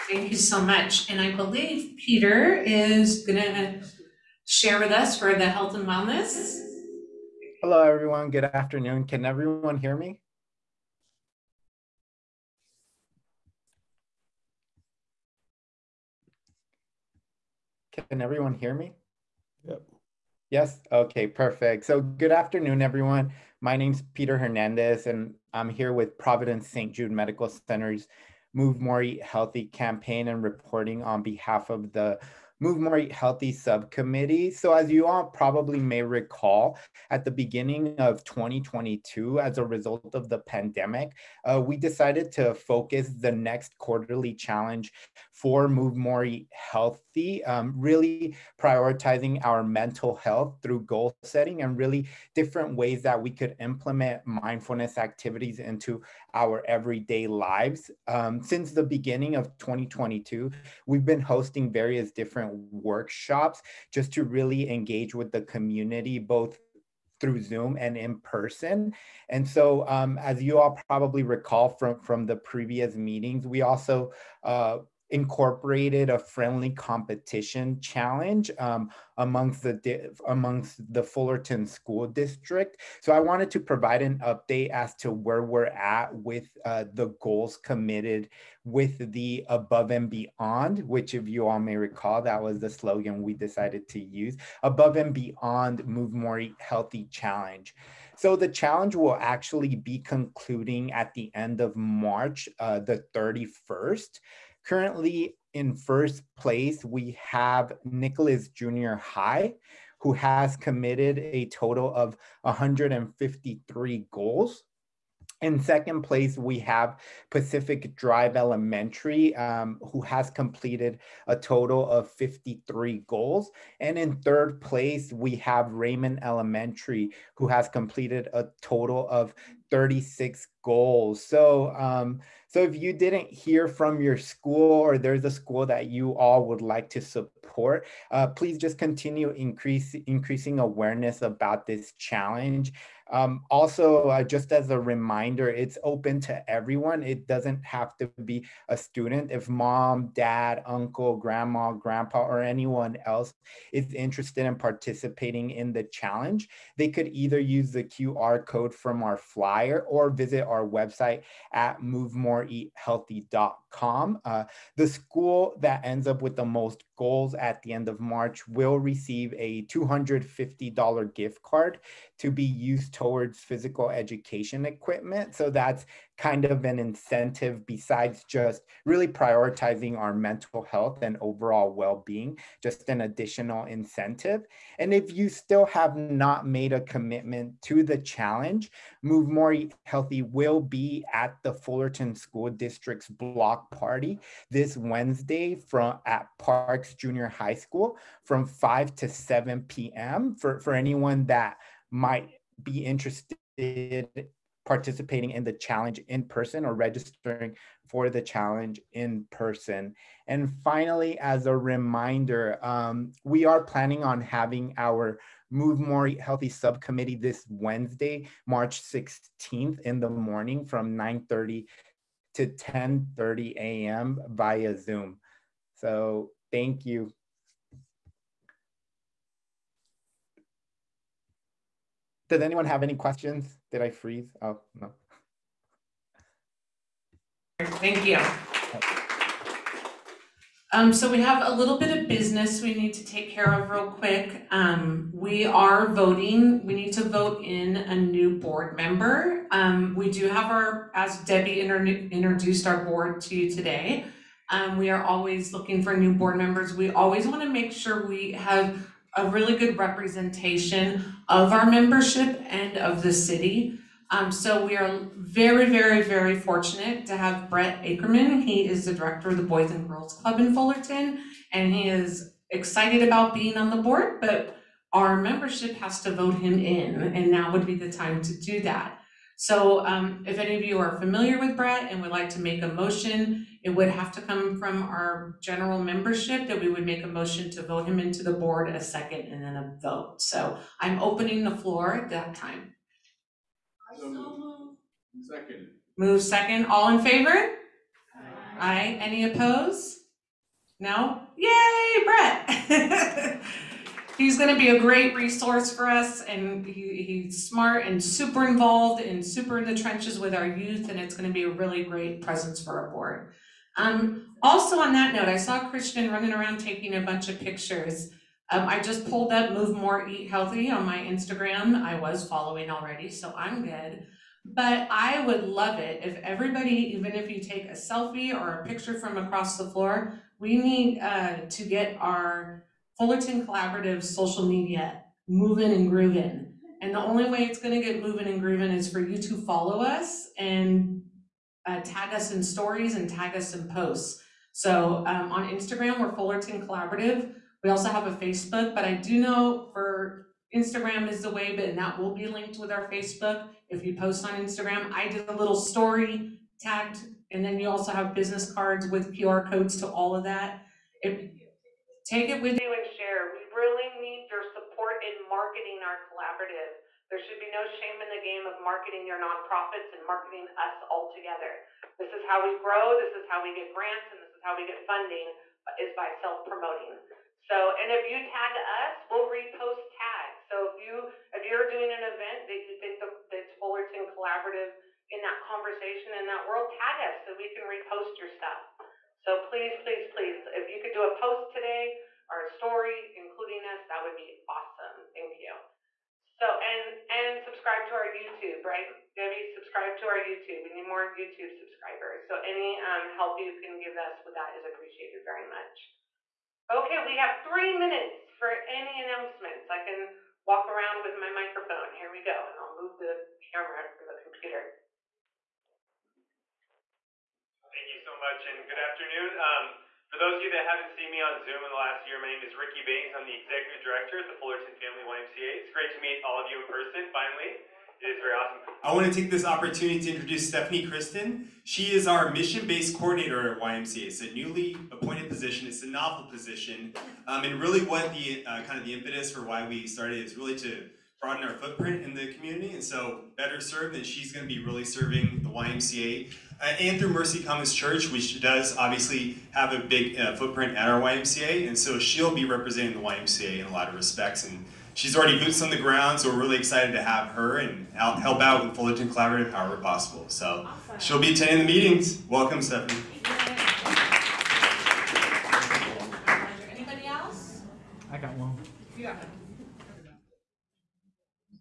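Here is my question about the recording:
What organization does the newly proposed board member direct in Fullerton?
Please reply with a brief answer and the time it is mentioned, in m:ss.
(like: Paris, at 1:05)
Boys and Girls Club, at 4:29.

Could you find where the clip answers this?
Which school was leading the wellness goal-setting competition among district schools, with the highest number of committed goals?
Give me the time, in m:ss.
1:47.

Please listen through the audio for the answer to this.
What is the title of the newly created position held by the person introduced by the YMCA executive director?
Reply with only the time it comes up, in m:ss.
7:12.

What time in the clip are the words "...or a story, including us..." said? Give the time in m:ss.
6:32.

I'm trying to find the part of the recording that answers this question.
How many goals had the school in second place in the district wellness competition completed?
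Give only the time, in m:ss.
2:02.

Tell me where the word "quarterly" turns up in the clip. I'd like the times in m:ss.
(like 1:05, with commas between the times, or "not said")
0:43.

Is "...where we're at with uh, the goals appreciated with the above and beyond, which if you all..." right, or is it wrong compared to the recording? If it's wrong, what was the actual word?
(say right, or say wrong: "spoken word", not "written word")
wrong: "committed", not "appreciated".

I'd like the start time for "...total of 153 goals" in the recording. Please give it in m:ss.
1:51.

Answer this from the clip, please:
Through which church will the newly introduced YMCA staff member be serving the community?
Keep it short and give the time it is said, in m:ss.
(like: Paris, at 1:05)
Mercy Commons Church, at 7:27.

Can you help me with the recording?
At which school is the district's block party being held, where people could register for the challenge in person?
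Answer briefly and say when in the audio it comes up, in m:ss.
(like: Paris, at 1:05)
Parks Junior High School, at 3:16.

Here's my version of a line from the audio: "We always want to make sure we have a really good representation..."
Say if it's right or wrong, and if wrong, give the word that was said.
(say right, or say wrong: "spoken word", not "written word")
right.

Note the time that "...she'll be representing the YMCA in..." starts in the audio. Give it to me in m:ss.
7:31.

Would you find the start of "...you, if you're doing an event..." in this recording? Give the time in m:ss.
6:20.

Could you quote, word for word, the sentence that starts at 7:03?
I'm the Executive Director at the Fullerton Family YMCA.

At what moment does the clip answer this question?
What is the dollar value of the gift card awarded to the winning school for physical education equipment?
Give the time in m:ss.
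2:49.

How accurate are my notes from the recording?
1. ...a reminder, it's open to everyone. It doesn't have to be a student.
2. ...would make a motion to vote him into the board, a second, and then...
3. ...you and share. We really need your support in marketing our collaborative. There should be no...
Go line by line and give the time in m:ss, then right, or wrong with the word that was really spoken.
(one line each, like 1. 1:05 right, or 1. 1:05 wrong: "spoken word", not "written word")
1. 2:24 right
2. 4:46 right
3. 6:02 right.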